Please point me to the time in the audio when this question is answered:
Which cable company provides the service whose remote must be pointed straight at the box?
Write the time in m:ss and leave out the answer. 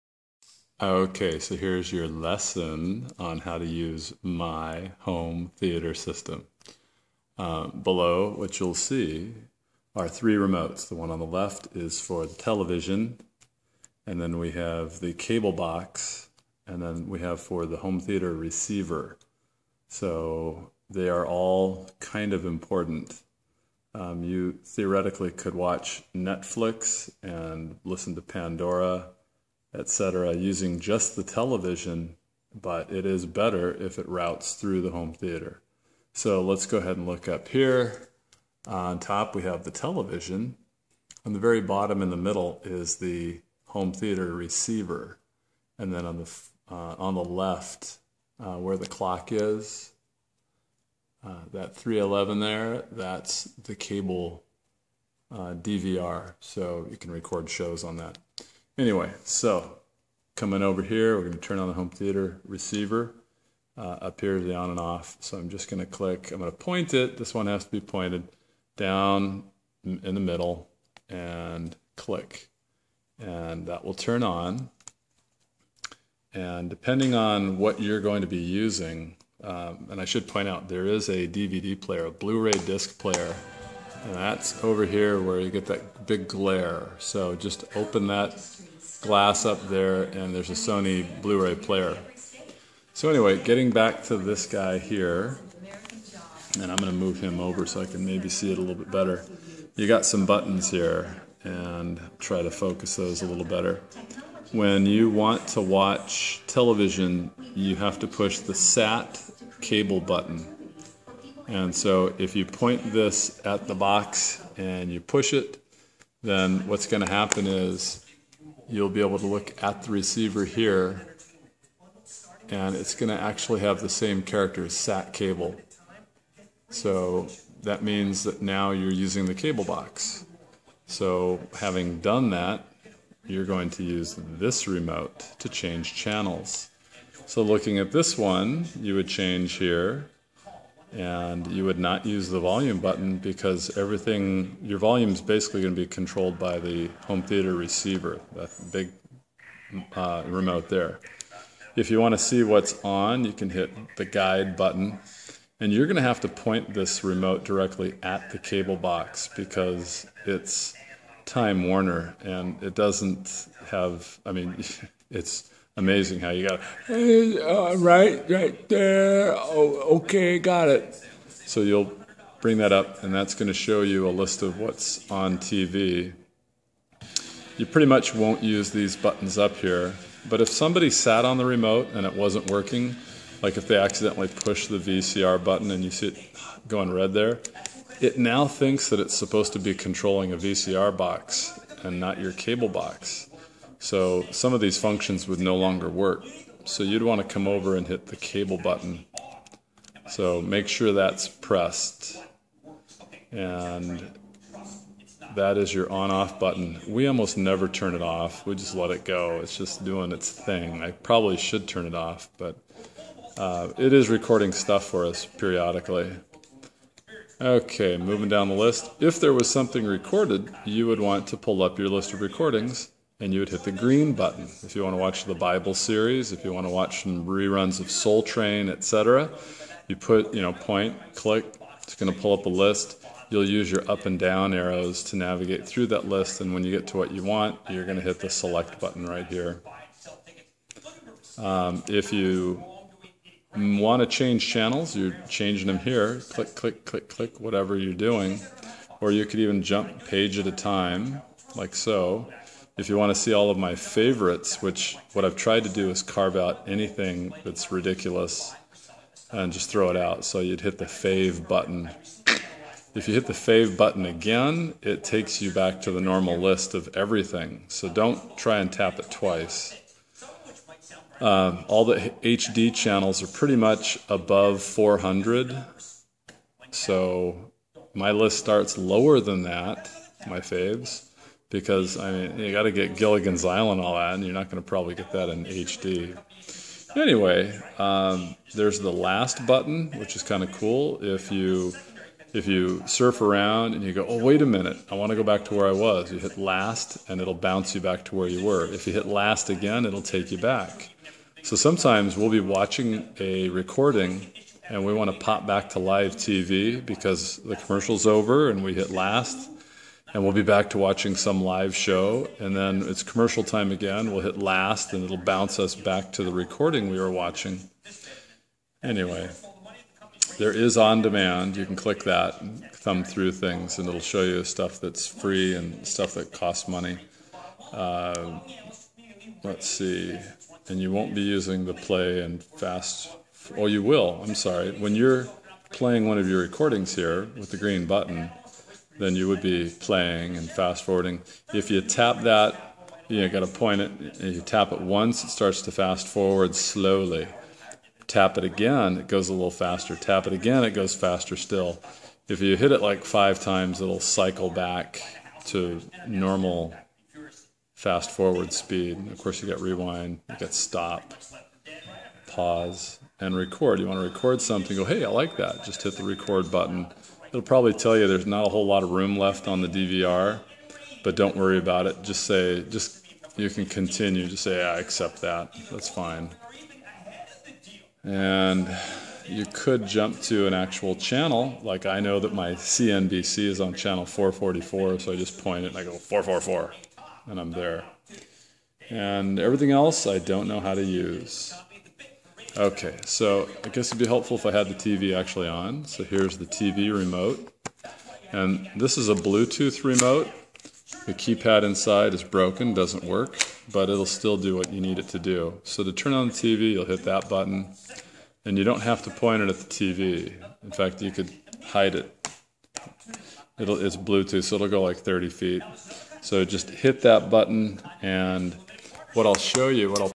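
2:41.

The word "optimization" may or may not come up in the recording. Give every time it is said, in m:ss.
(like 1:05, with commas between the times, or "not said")
not said.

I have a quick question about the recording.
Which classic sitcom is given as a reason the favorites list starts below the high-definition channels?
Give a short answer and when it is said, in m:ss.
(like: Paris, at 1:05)
Gilligan's Island, at 4:42.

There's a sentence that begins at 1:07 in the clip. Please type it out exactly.
This one has to be pointed down in the middle and click.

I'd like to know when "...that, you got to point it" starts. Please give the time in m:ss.
5:42.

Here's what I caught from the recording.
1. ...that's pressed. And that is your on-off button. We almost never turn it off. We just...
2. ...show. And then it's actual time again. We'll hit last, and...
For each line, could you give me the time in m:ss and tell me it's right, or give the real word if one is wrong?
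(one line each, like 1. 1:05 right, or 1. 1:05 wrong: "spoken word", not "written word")
1. 3:20 right
2. 5:11 wrong: "commercial", not "actual".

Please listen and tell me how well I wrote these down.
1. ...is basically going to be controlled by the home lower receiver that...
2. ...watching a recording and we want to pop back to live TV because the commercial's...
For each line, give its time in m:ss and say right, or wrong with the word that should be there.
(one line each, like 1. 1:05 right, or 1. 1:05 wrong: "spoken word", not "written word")
1. 2:25 wrong: "theater", not "lower"
2. 5:02 right.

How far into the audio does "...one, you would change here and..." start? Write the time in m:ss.
2:18.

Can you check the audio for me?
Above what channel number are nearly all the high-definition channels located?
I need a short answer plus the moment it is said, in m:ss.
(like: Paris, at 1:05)
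400, at 4:34.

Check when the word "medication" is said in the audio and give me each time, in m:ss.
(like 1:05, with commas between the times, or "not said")
not said.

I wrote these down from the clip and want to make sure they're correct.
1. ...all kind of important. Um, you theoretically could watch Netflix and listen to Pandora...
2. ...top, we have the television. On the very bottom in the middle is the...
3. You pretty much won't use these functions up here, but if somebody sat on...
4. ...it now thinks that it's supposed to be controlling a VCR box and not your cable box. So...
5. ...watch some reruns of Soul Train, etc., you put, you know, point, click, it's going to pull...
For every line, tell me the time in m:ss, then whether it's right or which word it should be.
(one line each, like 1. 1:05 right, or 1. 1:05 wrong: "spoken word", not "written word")
1. 0:21 right
2. 0:38 right
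3. 2:57 wrong: "buttons", not "functions"
4. 3:07 right
5. 3:46 right.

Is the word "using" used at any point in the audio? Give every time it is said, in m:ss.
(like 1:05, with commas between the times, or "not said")
0:30, 1:18, 2:08, 5:31.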